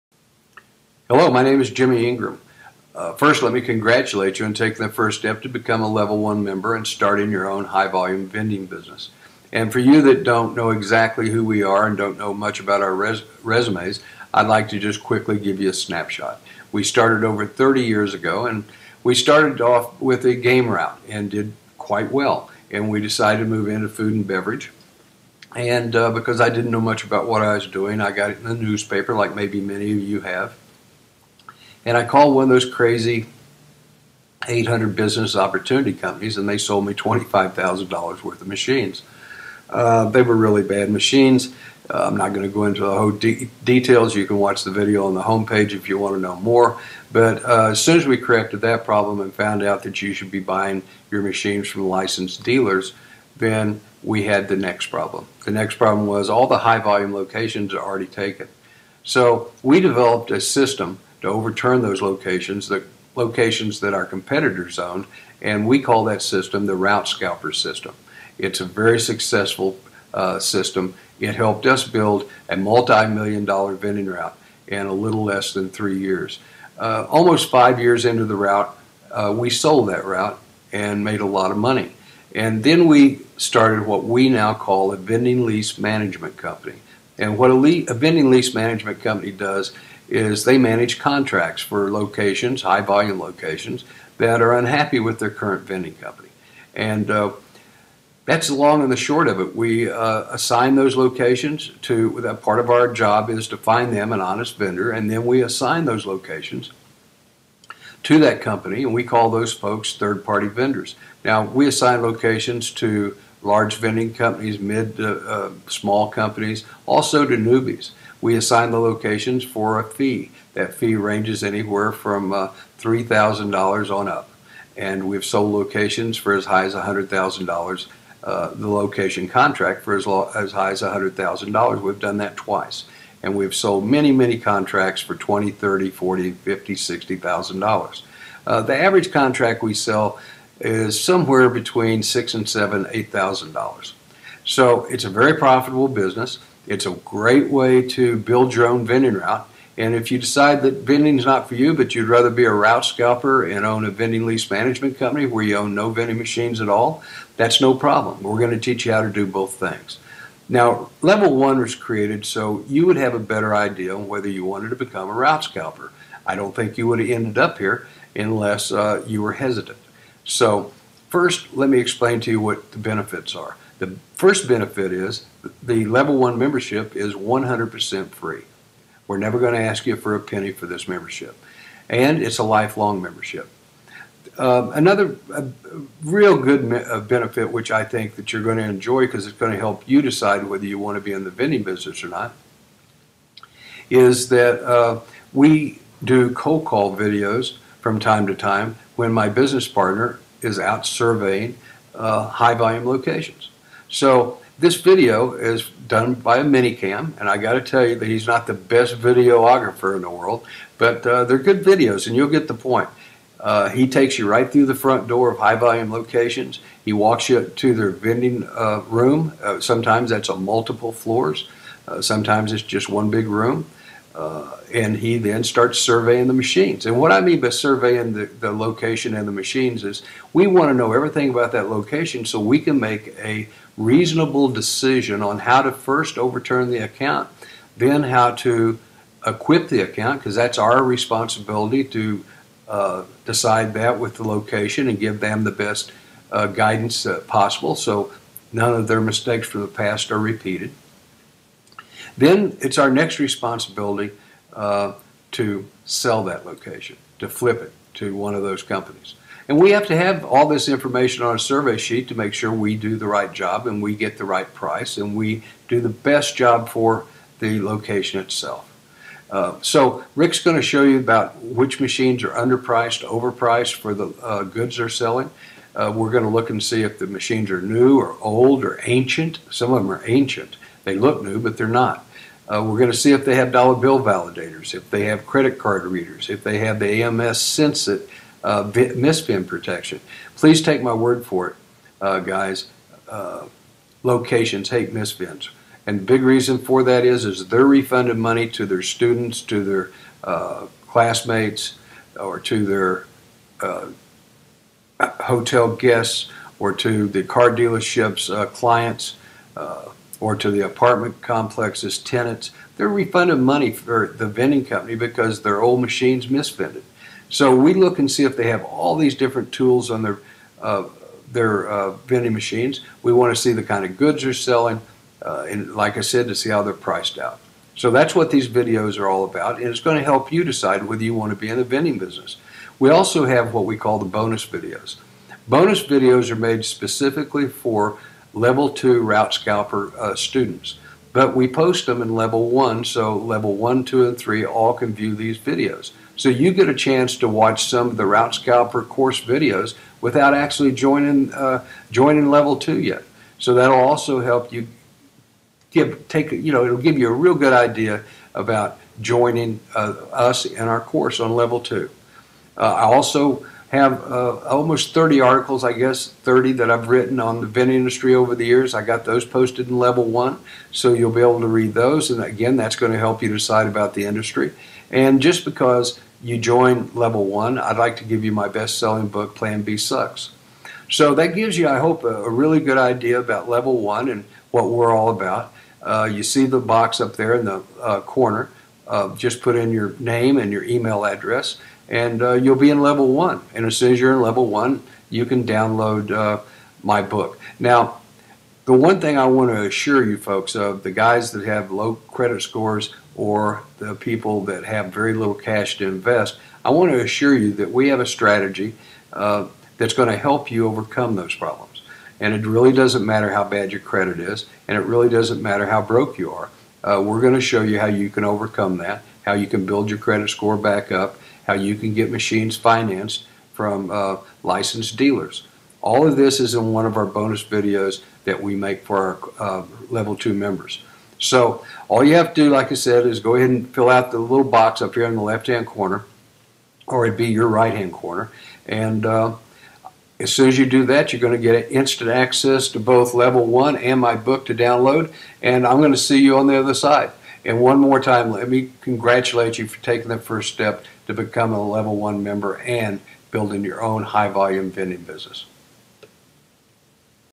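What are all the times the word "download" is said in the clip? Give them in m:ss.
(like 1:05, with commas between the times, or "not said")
6:35, 7:24.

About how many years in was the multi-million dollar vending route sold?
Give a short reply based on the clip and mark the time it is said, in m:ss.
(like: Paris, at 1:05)
5, at 1:17.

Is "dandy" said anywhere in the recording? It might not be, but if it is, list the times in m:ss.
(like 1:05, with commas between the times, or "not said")
not said.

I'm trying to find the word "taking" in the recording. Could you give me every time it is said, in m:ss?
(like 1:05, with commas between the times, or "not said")
0:04, 7:29.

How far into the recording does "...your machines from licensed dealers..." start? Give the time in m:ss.
0:51.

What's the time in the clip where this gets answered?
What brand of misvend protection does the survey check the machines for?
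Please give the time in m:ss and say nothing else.
4:47.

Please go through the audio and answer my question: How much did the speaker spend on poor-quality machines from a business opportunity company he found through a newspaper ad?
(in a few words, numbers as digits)
$25,000.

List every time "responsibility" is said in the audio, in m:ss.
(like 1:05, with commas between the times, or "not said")
4:00, 4:13.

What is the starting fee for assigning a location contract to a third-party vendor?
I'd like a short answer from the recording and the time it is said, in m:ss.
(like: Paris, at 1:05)
$3,000, at 2:02.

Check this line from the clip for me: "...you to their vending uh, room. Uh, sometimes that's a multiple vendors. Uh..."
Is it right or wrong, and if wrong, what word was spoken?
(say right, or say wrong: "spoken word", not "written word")
wrong: "floors", not "vendors".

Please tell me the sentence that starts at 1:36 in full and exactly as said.
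And uh, that's the long and the short of it.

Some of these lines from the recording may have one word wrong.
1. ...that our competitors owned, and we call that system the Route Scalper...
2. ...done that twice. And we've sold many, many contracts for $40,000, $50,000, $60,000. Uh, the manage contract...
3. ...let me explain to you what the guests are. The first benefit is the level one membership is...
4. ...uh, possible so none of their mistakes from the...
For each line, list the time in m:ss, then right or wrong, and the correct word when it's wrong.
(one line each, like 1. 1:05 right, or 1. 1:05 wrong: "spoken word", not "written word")
1. 1:03 right
2. 2:11 wrong: "average", not "manage"
3. 2:51 wrong: "benefits", not "guests"
4. 4:07 right.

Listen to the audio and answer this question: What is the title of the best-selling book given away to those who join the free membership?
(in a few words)
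Plan B Sucks.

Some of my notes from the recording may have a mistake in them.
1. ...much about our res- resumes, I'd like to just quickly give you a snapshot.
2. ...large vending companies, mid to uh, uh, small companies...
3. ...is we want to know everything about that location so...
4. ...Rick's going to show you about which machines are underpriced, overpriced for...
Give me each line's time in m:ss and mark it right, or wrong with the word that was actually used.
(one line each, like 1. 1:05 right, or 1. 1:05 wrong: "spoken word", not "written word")
1. 0:12 right
2. 1:53 right
3. 3:49 right
4. 4:30 right.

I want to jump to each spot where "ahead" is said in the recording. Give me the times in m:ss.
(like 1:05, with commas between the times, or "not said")
7:13.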